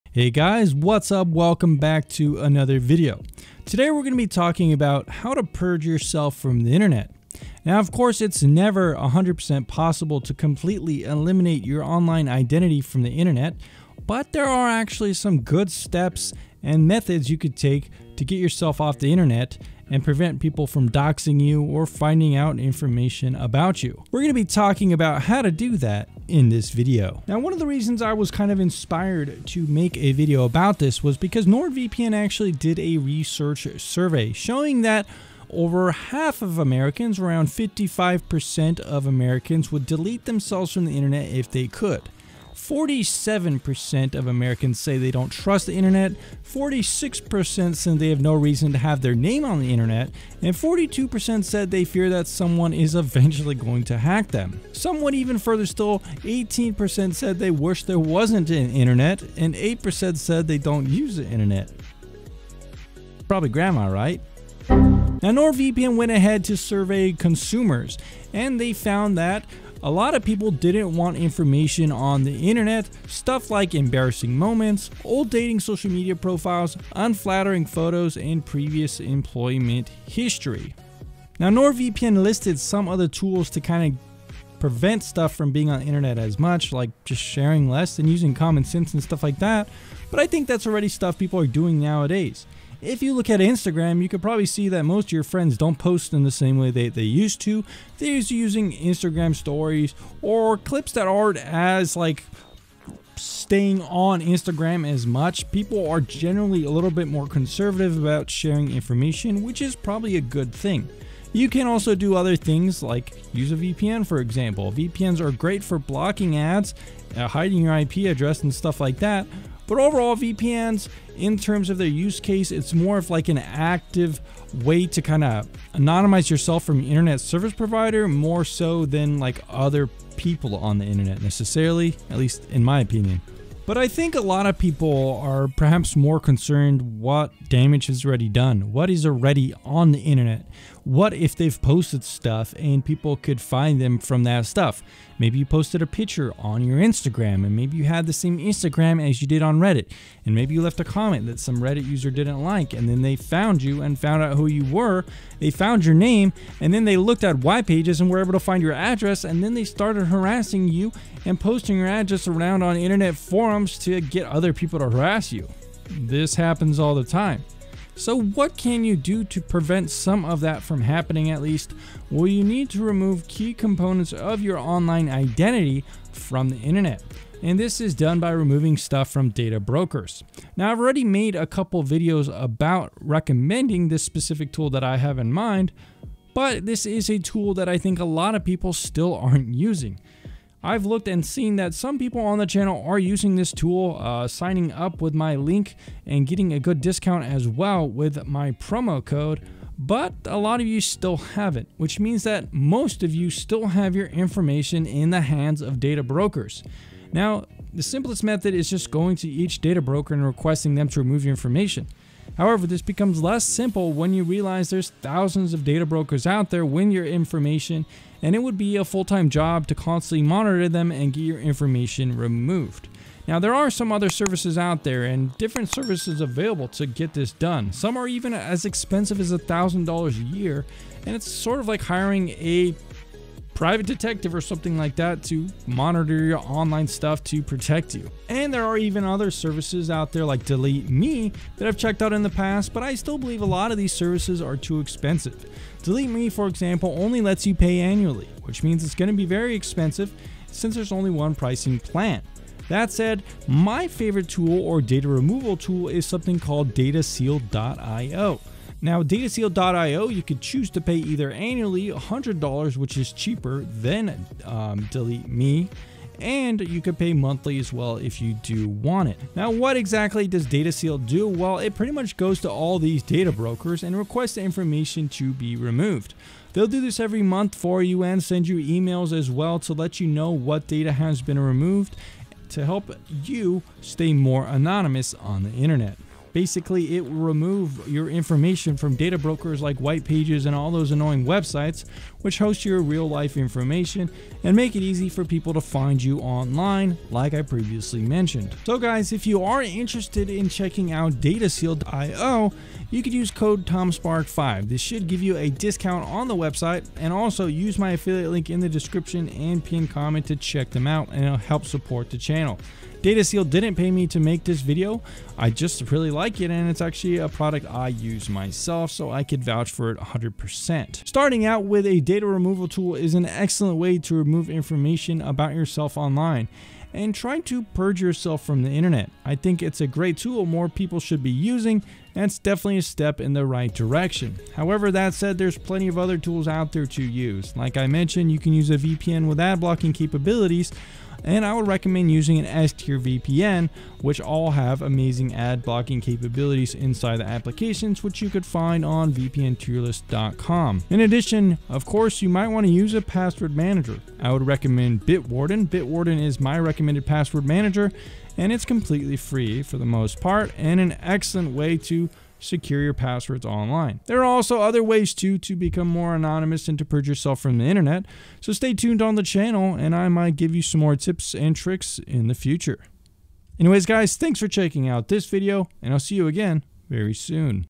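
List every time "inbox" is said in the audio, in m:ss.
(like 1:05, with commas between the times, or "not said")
not said.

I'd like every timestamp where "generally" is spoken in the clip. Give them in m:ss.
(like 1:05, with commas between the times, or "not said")
1:46.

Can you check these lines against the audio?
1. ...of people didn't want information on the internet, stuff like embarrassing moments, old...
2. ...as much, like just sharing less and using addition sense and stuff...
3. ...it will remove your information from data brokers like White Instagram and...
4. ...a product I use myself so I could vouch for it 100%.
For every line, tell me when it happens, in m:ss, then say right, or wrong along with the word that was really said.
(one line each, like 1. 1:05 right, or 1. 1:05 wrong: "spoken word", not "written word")
1. 1:10 right
2. 1:26 wrong: "common", not "addition"
3. 4:46 wrong: "Pages", not "Instagram"
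4. 5:17 right.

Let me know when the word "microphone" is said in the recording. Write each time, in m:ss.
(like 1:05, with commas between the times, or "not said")
not said.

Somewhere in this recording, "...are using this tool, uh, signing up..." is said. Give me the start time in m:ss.
3:12.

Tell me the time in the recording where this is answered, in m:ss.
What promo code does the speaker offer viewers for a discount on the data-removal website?
5:03.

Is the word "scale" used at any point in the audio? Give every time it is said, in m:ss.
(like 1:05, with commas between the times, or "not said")
not said.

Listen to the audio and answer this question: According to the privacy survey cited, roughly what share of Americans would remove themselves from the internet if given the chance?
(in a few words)
55%.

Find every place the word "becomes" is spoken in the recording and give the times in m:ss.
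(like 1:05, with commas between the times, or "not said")
3:32, 6:05.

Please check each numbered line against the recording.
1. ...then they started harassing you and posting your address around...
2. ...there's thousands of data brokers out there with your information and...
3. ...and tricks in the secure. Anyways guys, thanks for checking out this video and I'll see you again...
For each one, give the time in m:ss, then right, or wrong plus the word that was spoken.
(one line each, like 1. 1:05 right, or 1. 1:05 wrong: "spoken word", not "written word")
1. 2:39 right
2. 3:34 right
3. 6:11 wrong: "future", not "secure".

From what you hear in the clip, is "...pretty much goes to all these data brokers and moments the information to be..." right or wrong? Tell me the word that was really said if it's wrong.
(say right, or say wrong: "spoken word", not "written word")
wrong: "requests", not "moments".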